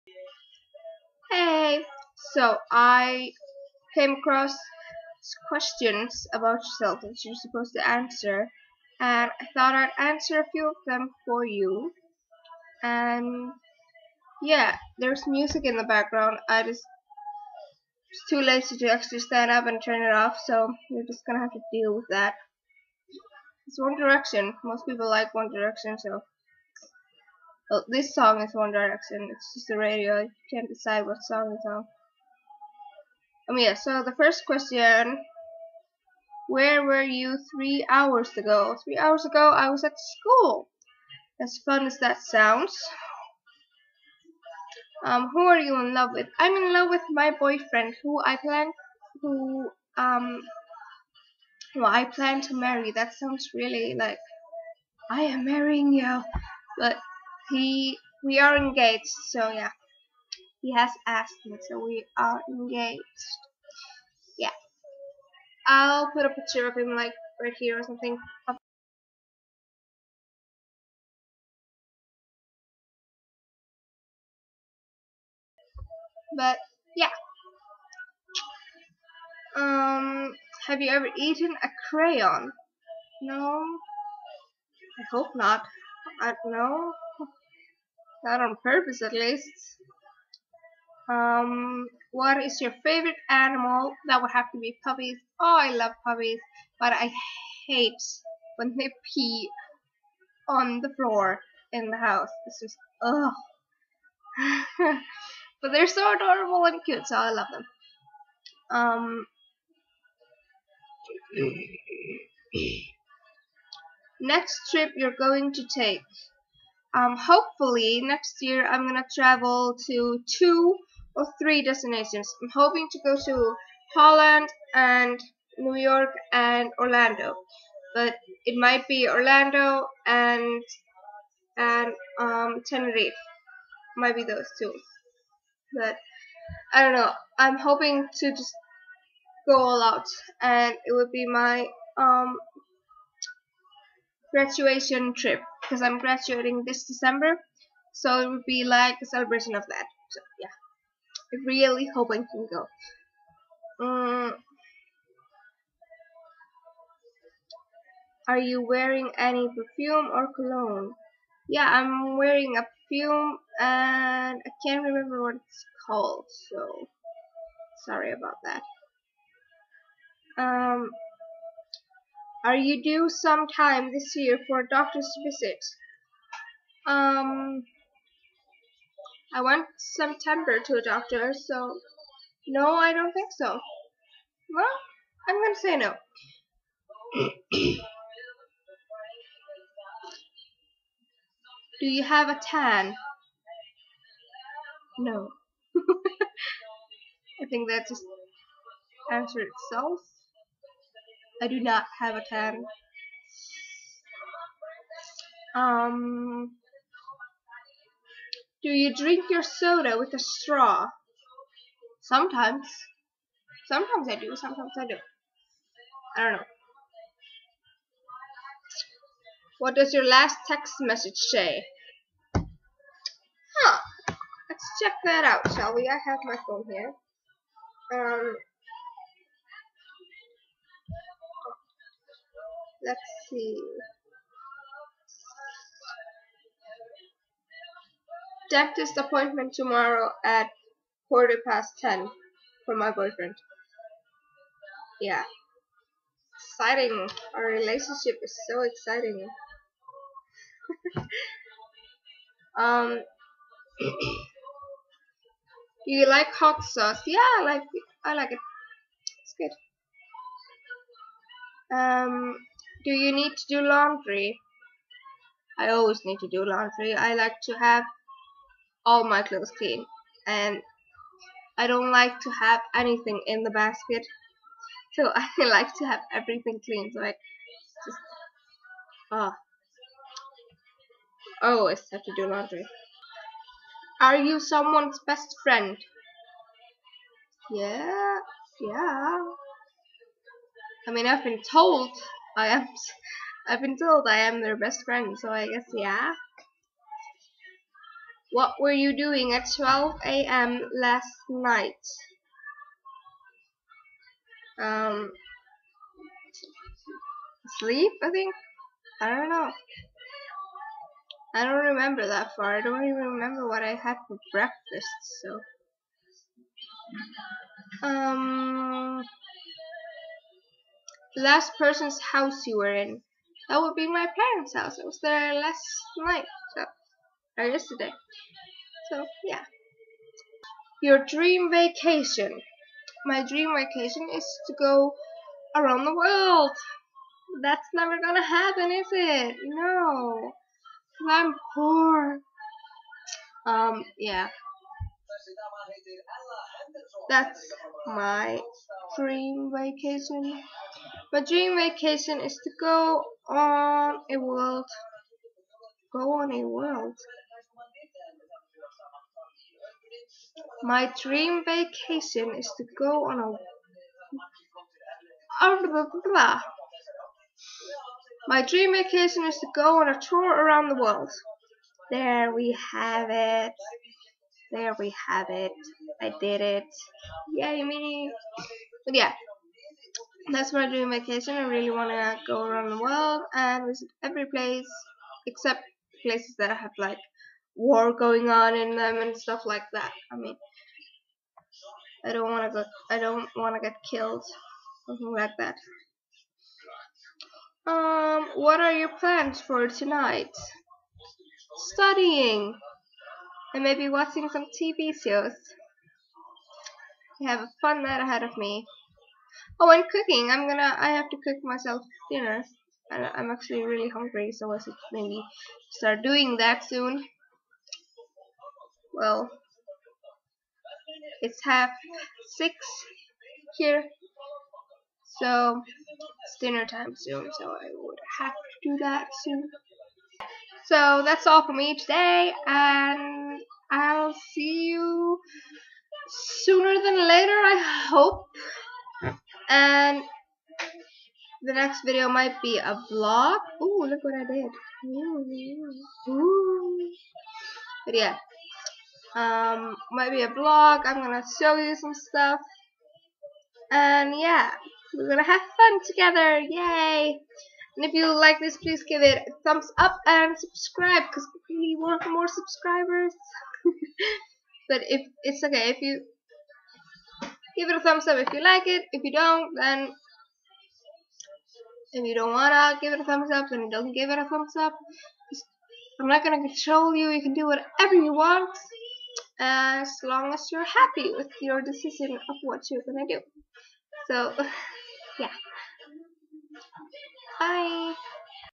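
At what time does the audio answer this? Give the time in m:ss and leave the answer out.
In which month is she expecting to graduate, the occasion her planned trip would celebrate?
2:26.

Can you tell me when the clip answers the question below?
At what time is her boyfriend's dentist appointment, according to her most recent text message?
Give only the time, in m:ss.
4:01.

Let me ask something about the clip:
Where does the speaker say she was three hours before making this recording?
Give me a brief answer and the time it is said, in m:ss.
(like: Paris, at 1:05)
School, at 0:39.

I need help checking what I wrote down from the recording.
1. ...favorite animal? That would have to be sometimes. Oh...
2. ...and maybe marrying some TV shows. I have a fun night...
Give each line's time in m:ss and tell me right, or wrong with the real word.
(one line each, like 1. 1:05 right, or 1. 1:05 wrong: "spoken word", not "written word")
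1. 1:32 wrong: "puppies", not "sometimes"
2. 6:43 wrong: "watching", not "marrying".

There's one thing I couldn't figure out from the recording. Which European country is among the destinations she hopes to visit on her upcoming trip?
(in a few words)
Holland.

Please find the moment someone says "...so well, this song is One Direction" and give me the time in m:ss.
0:25.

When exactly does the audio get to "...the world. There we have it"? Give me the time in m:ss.
6:10.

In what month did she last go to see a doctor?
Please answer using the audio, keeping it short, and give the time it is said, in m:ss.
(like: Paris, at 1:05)
September, at 2:59.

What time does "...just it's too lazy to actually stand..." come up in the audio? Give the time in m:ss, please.
0:16.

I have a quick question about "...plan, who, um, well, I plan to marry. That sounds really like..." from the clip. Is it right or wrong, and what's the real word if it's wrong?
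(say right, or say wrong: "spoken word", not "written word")
right.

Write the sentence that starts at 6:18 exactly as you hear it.
But yeah, that's what I do in vacation.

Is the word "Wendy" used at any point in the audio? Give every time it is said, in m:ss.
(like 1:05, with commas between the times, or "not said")
not said.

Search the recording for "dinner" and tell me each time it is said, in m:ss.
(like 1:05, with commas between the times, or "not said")
6:52, 7:06.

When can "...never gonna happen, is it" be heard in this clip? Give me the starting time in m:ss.
5:37.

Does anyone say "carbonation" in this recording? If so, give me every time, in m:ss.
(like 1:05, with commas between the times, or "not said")
not said.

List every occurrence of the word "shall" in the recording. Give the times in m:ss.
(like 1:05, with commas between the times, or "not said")
3:45.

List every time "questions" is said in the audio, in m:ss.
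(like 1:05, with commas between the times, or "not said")
0:05, 0:34.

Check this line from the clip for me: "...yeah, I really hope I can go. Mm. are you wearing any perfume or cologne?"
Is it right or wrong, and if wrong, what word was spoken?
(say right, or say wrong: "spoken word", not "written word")
right.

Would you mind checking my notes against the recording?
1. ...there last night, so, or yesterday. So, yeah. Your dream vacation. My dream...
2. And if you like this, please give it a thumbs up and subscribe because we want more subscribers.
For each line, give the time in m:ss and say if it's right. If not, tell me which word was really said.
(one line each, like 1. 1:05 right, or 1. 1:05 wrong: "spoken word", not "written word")
1. 5:25 right
2. 7:37 right.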